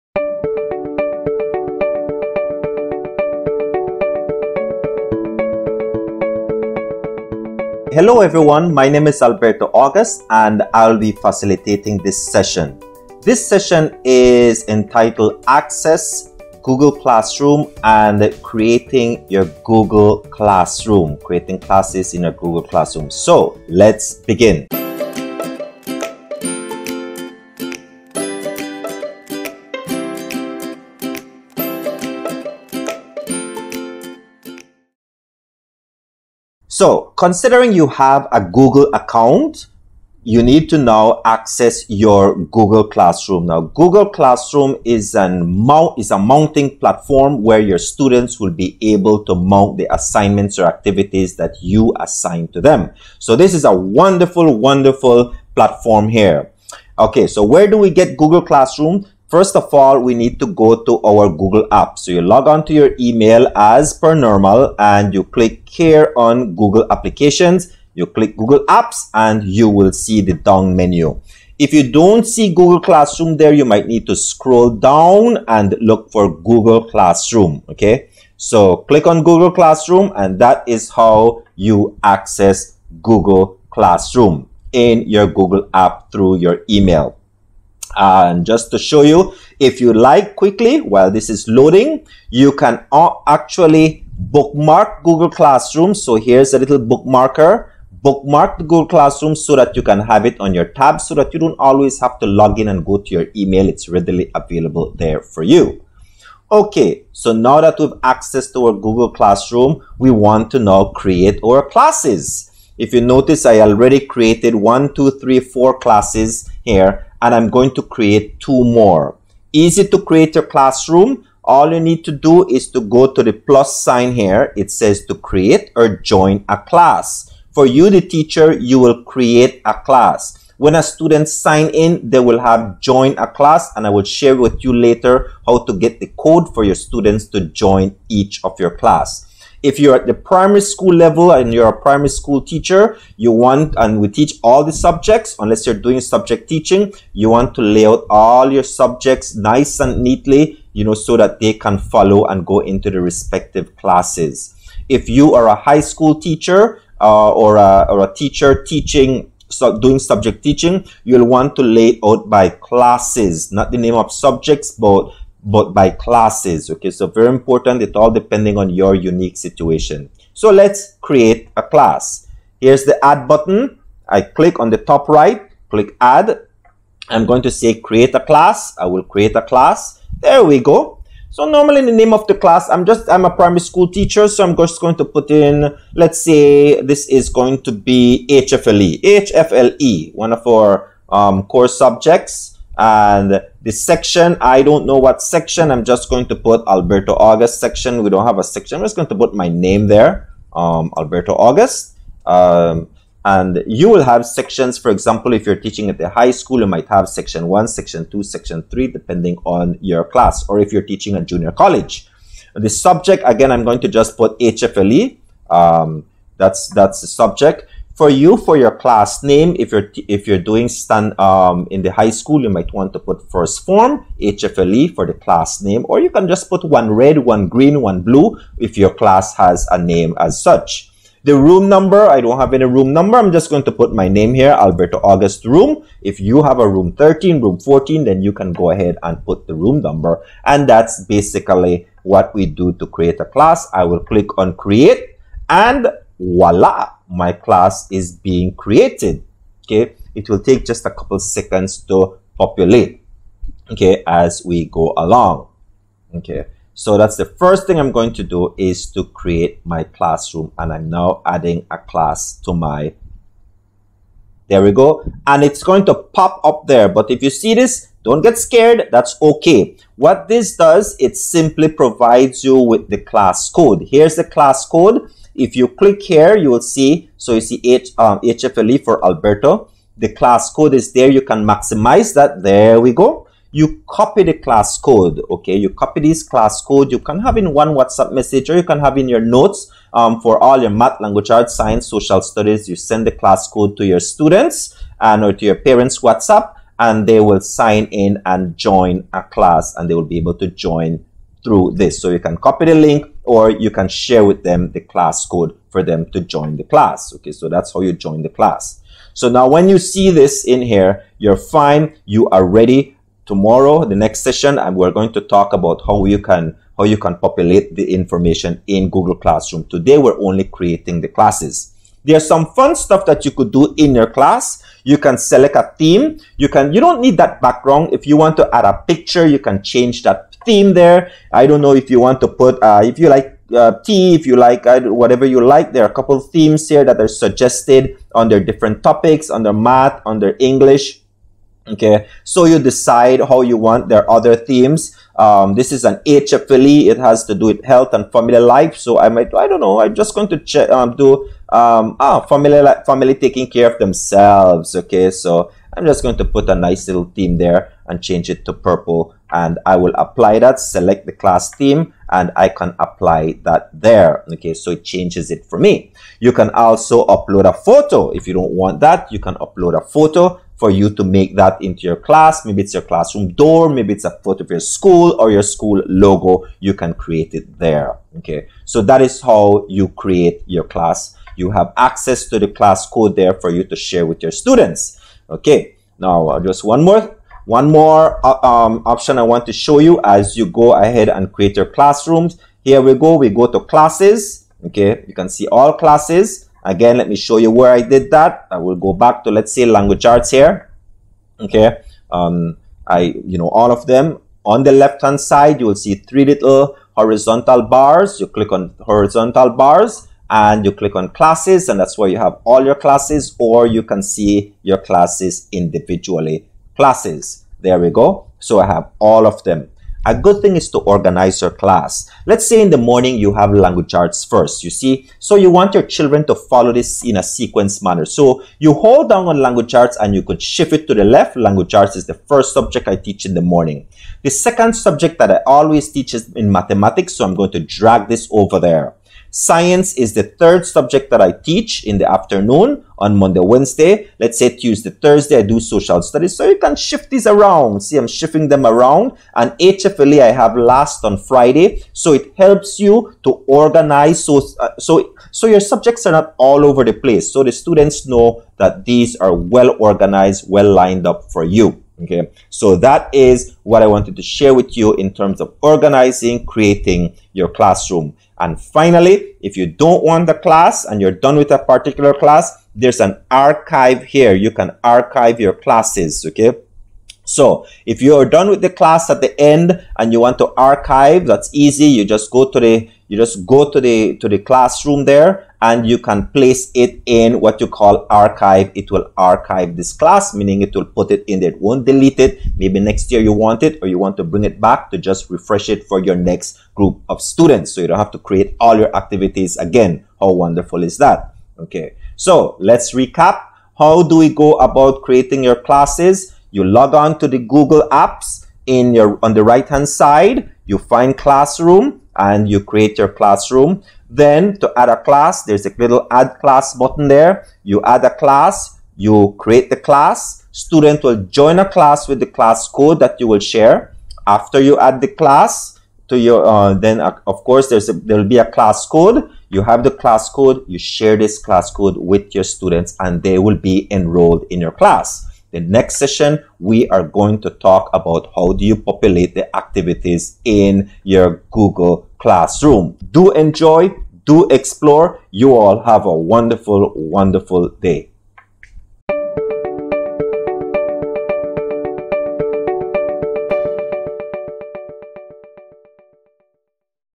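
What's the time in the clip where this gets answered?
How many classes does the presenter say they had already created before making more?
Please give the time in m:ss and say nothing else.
1:54.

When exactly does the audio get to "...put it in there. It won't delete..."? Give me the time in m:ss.
8:10.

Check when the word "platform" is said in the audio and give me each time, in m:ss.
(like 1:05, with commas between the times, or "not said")
0:46, 0:55.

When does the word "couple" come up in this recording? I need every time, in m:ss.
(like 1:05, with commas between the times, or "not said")
4:10, 5:35.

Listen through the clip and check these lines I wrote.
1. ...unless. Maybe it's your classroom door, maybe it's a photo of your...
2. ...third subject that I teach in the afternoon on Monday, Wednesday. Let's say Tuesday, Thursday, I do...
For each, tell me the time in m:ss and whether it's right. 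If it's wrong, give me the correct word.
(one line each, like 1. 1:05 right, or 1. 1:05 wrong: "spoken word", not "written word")
1. 6:11 wrong: "class", not "unless"
2. 7:20 right.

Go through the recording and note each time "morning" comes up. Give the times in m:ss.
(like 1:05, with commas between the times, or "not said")
7:02, 7:13.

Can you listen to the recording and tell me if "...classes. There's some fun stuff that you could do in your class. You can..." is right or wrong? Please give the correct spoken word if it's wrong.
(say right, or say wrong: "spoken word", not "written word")
right.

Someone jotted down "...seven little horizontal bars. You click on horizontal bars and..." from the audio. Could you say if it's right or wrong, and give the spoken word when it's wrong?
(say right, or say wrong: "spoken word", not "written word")
wrong: "three", not "seven".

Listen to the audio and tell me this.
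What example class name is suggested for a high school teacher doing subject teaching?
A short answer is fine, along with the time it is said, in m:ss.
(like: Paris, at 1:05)
first form HFLE, at 3:43.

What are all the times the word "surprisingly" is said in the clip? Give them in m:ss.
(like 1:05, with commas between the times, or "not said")
not said.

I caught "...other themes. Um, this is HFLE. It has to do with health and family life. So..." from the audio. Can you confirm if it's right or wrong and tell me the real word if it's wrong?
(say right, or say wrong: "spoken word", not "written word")
right.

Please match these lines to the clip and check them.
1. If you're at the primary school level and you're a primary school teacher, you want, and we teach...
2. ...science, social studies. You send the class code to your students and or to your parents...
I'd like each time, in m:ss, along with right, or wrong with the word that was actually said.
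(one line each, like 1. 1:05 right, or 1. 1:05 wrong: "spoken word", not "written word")
1. 2:19 right
2. 4:51 right.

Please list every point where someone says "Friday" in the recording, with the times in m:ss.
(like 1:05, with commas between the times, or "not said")
7:31.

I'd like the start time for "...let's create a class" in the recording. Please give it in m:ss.
2:50.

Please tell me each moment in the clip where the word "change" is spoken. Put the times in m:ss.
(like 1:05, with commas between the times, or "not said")
5:29, 5:58, 6:04.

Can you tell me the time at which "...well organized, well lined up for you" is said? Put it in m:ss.
7:39.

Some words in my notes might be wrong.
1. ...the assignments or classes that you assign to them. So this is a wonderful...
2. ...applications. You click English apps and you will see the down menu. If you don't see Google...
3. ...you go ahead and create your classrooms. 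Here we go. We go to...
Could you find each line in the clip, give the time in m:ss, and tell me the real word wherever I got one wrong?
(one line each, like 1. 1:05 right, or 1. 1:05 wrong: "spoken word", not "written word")
1. 0:49 wrong: "activities", not "classes"
2. 1:06 wrong: "Google", not "English"
3. 6:30 right.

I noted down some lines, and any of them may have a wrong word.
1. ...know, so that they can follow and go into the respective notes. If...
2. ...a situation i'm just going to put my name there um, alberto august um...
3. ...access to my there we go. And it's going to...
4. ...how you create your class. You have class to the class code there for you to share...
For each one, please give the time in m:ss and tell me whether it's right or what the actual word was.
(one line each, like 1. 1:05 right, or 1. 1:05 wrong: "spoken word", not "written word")
1. 2:30 wrong: "classes", not "notes"
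2. 3:18 wrong: "section", not "situation"
3. 4:21 wrong: "class", not "access"
4. 6:19 wrong: "access", not "class".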